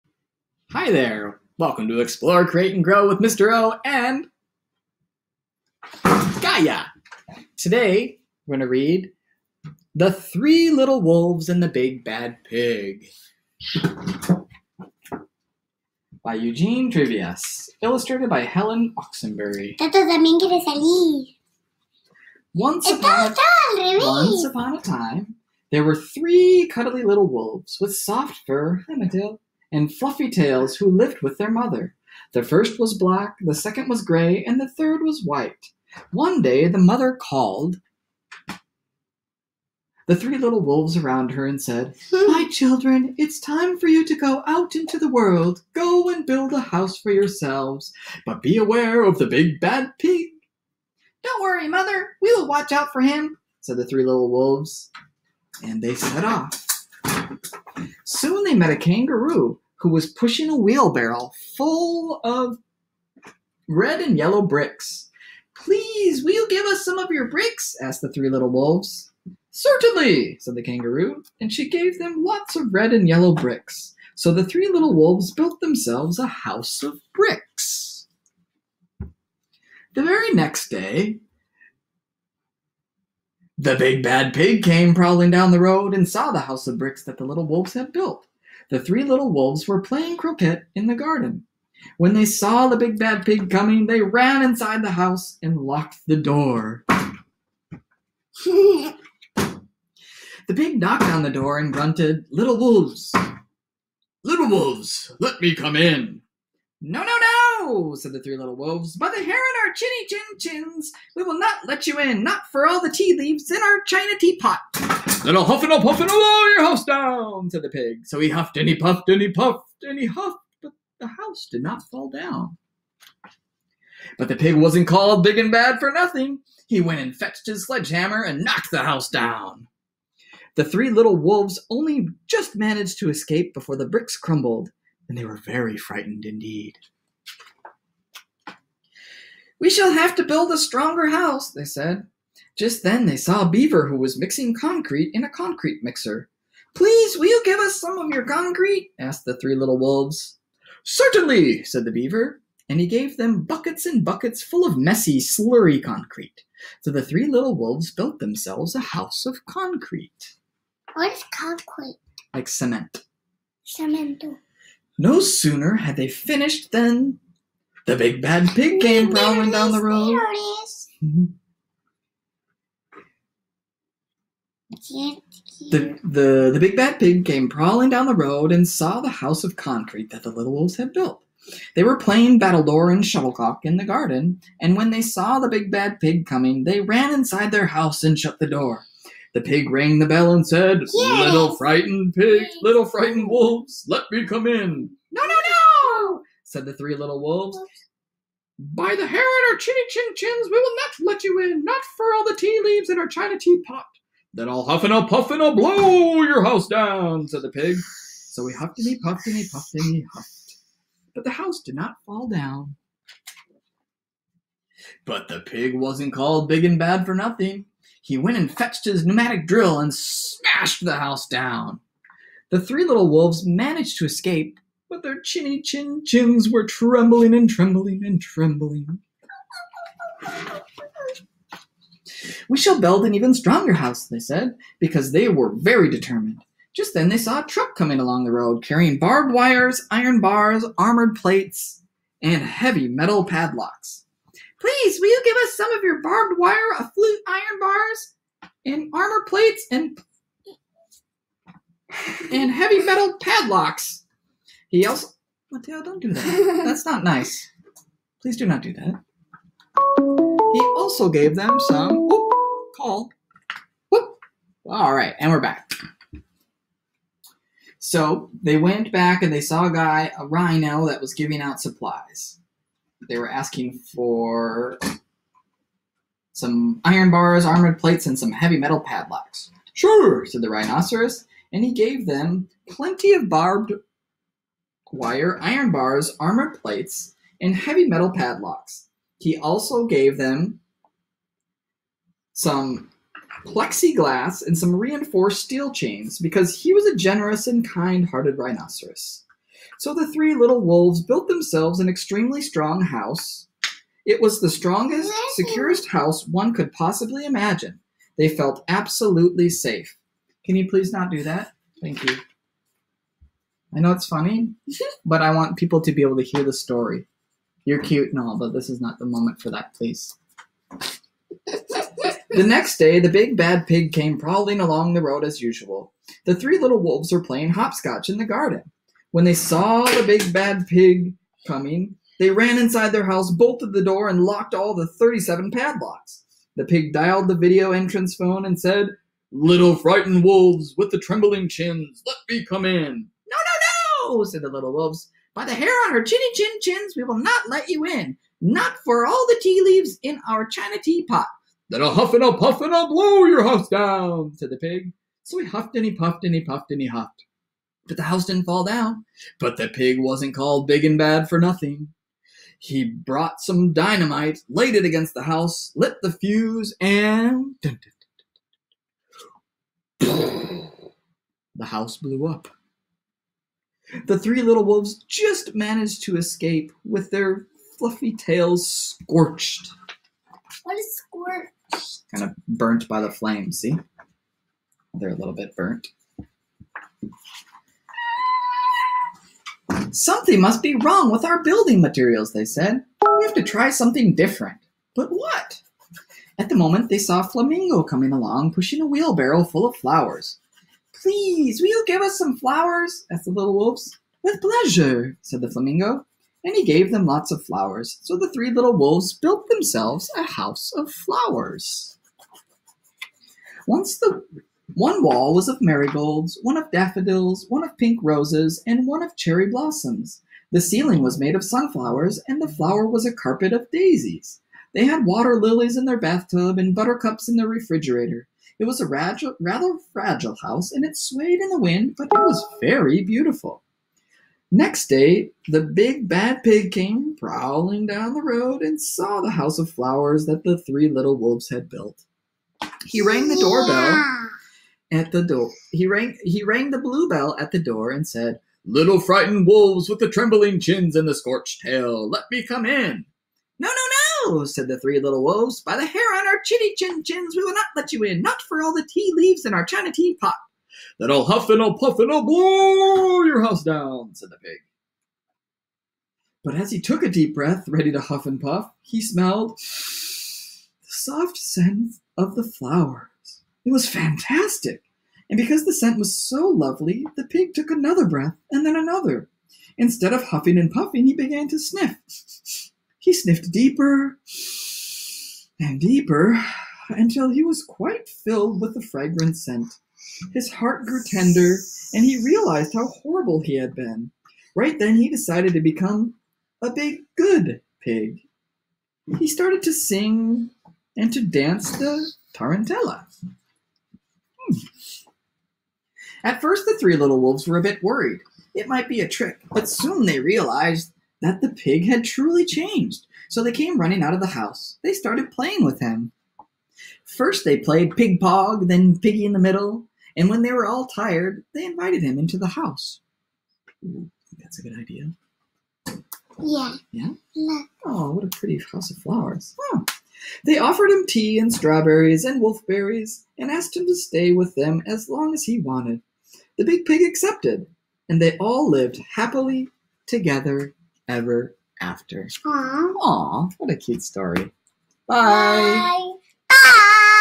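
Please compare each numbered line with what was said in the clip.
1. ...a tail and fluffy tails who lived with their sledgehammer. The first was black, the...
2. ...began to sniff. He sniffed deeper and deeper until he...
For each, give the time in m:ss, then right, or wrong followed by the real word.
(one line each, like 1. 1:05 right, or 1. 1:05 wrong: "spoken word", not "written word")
1. 0:29 wrong: "mother", not "sledgehammer"
2. 8:01 right.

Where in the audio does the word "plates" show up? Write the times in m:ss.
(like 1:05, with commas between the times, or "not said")
4:01, 4:09, 4:37, 4:46.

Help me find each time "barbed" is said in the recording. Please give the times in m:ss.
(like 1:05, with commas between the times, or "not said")
3:58, 4:06, 4:43.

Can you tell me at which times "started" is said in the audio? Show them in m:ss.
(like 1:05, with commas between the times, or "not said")
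8:19, 8:34.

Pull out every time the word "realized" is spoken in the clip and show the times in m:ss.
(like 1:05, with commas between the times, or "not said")
8:12, 8:30.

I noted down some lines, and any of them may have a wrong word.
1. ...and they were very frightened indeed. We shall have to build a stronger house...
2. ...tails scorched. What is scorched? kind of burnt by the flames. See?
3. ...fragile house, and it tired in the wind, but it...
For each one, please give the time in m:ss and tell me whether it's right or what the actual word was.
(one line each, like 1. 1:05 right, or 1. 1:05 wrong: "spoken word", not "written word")
1. 2:15 right
2. 6:18 right
3. 7:09 wrong: "swayed", not "tired".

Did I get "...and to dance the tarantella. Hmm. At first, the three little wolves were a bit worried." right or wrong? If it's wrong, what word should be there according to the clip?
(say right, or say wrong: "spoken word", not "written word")
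right.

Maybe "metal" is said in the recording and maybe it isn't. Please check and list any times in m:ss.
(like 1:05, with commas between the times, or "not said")
4:02, 4:12, 4:38, 4:47.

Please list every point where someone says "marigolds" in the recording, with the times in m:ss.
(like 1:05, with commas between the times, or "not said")
6:55.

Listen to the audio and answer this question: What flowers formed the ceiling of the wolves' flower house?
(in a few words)
sunflowers.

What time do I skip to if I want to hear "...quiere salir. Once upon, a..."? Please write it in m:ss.
0:20.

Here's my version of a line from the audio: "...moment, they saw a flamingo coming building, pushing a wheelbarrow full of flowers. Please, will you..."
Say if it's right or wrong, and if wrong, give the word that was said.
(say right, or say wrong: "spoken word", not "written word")
wrong: "along", not "building".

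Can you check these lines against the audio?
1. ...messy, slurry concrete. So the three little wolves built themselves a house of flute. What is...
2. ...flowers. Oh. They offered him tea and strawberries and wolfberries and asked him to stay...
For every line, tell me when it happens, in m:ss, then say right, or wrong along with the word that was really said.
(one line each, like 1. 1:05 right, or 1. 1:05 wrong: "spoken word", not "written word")
1. 2:34 wrong: "concrete", not "flute"
2. 8:48 right.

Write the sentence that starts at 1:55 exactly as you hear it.
Little huffin' up, huffin' all your house down, said the pig.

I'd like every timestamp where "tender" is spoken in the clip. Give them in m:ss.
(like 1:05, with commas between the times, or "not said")
8:11.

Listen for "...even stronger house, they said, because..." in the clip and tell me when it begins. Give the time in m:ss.
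3:53.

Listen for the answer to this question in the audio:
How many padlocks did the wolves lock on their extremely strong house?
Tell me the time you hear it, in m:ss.
5:34.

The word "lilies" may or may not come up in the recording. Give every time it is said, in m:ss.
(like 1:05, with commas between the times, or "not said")
7:05.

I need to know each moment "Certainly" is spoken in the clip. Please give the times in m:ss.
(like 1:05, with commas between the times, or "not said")
1:09, 2:30.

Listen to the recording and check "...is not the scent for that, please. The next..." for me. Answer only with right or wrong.
wrong.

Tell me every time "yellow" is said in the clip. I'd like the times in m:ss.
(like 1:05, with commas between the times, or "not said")
1:04, 1:13.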